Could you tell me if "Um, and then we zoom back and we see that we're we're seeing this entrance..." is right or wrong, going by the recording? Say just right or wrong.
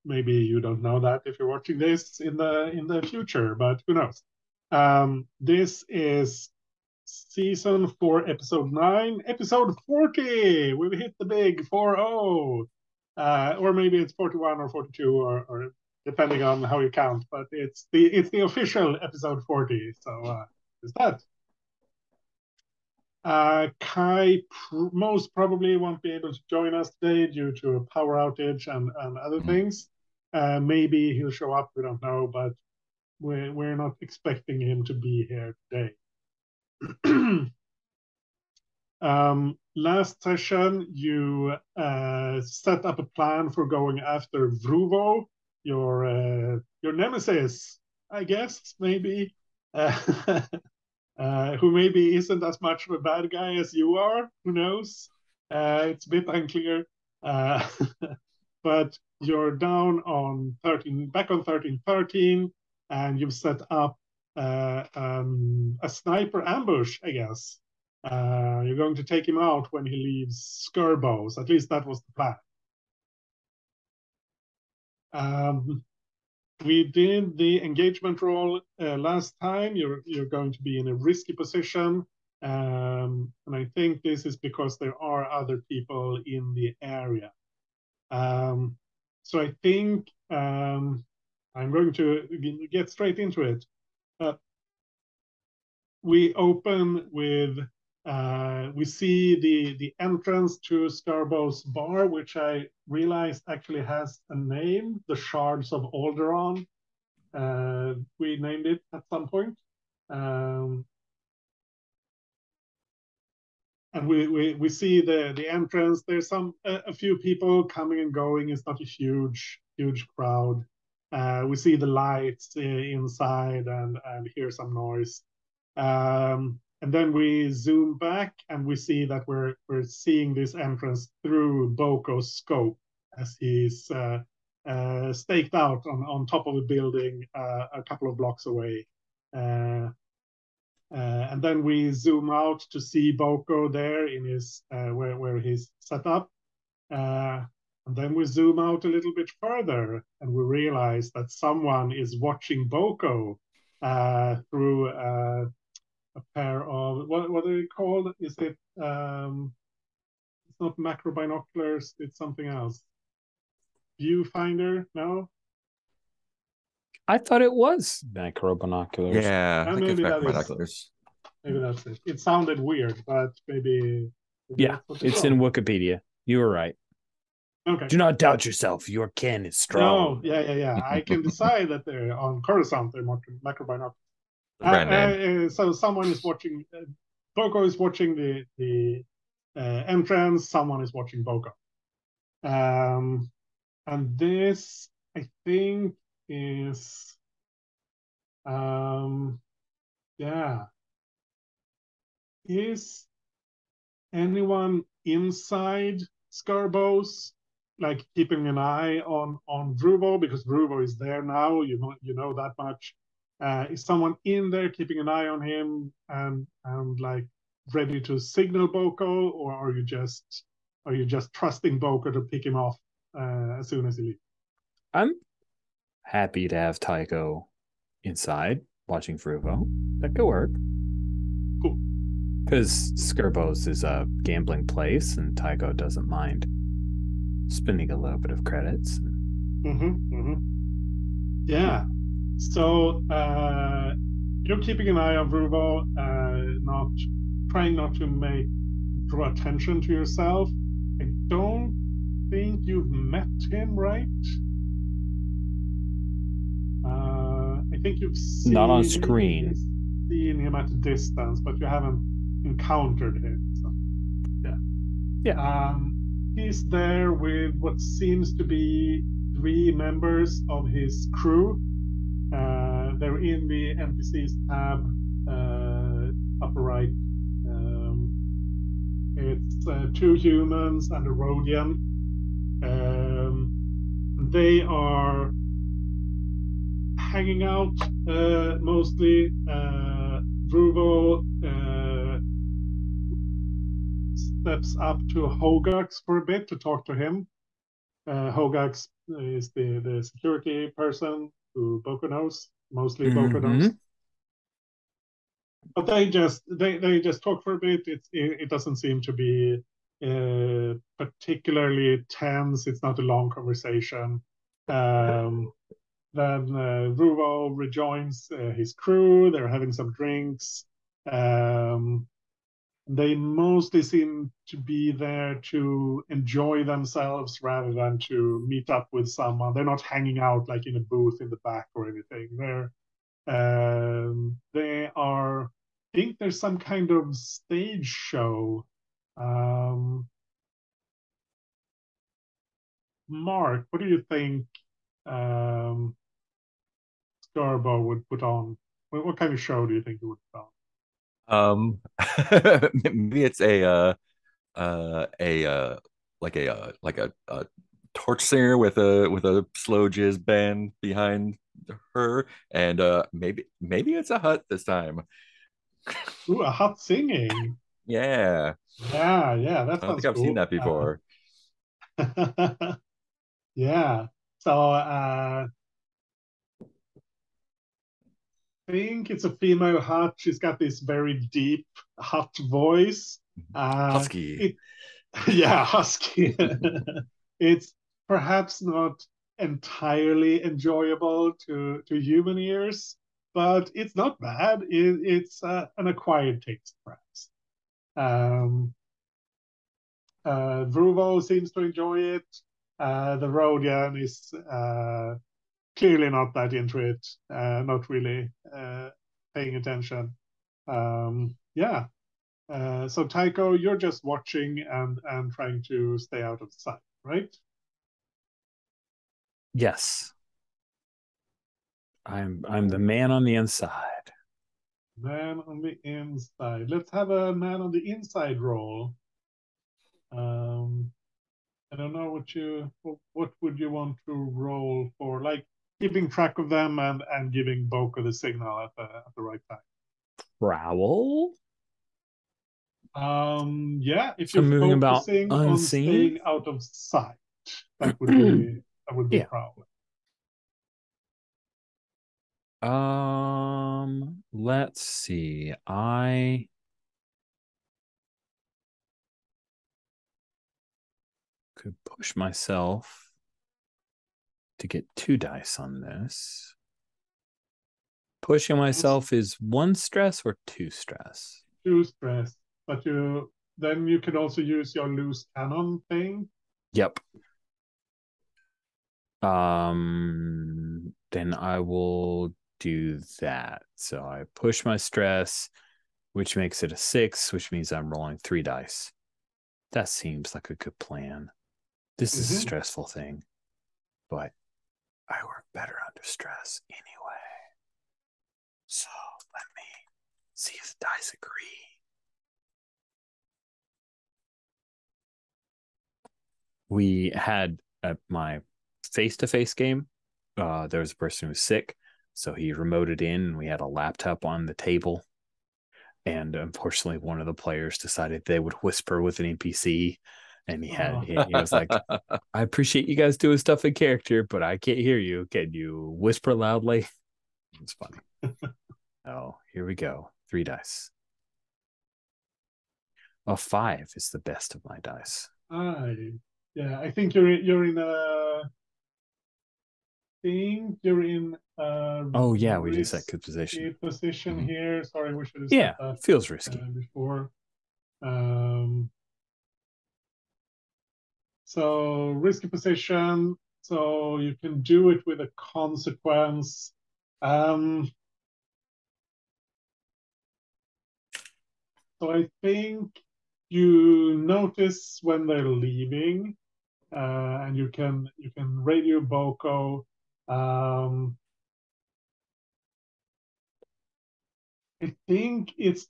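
right.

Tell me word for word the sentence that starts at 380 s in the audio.
She's got this very deep, hot voice.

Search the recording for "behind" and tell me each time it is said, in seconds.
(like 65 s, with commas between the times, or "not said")
360 s.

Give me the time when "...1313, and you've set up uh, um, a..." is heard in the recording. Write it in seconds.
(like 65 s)
61 s.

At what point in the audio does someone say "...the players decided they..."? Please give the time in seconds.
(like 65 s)
517 s.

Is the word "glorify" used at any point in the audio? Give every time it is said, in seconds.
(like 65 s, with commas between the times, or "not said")
not said.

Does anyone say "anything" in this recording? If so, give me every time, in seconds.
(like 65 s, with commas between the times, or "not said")
331 s.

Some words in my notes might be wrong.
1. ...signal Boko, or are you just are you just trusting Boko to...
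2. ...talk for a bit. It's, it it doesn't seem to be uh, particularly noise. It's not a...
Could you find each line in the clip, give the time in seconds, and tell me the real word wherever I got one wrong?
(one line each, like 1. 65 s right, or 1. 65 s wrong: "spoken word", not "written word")
1. 218 s right
2. 307 s wrong: "tense", not "noise".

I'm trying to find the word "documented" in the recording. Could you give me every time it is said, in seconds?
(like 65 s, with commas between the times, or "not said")
not said.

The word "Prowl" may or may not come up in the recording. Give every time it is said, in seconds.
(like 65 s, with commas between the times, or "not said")
440 s, 449 s.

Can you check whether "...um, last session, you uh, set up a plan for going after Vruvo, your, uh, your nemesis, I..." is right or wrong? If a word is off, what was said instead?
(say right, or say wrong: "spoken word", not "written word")
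right.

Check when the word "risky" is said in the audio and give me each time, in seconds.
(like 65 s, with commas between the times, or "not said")
80 s, 546 s, 552 s.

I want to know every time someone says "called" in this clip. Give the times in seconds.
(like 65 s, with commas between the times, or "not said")
157 s, 175 s.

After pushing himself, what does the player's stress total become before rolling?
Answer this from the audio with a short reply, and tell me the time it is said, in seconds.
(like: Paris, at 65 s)
6, at 486 s.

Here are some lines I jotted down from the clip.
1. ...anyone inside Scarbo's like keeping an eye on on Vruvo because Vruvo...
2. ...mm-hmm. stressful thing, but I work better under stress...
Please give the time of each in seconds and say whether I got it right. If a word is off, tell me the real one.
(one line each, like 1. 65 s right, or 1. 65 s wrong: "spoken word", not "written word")
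1. 204 s right
2. 492 s right.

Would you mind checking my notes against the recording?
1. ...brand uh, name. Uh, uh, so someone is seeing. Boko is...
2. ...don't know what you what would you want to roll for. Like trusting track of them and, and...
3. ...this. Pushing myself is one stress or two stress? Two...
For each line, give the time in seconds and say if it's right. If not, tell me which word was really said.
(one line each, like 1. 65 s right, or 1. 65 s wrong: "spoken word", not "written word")
1. 184 s wrong: "watching", not "seeing"
2. 431 s wrong: "keeping", not "trusting"
3. 465 s right.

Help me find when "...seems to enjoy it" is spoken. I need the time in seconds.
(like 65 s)
401 s.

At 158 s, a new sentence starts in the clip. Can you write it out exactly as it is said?
Is it um, it's not macro binoculars, it's something else.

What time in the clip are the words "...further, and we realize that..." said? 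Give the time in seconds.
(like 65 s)
149 s.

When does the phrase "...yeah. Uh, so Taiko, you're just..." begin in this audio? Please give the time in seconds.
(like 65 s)
411 s.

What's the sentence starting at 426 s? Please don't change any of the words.
Let's have a man on the inside roll.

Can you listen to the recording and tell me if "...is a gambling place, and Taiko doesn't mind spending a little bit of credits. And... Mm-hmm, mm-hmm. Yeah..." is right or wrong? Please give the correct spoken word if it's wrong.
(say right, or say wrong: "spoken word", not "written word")
right.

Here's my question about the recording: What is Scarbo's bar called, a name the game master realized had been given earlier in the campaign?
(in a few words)
Shards of Alderaan.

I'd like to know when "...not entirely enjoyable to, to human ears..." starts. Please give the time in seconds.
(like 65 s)
388 s.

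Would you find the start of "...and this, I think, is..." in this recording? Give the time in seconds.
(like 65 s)
193 s.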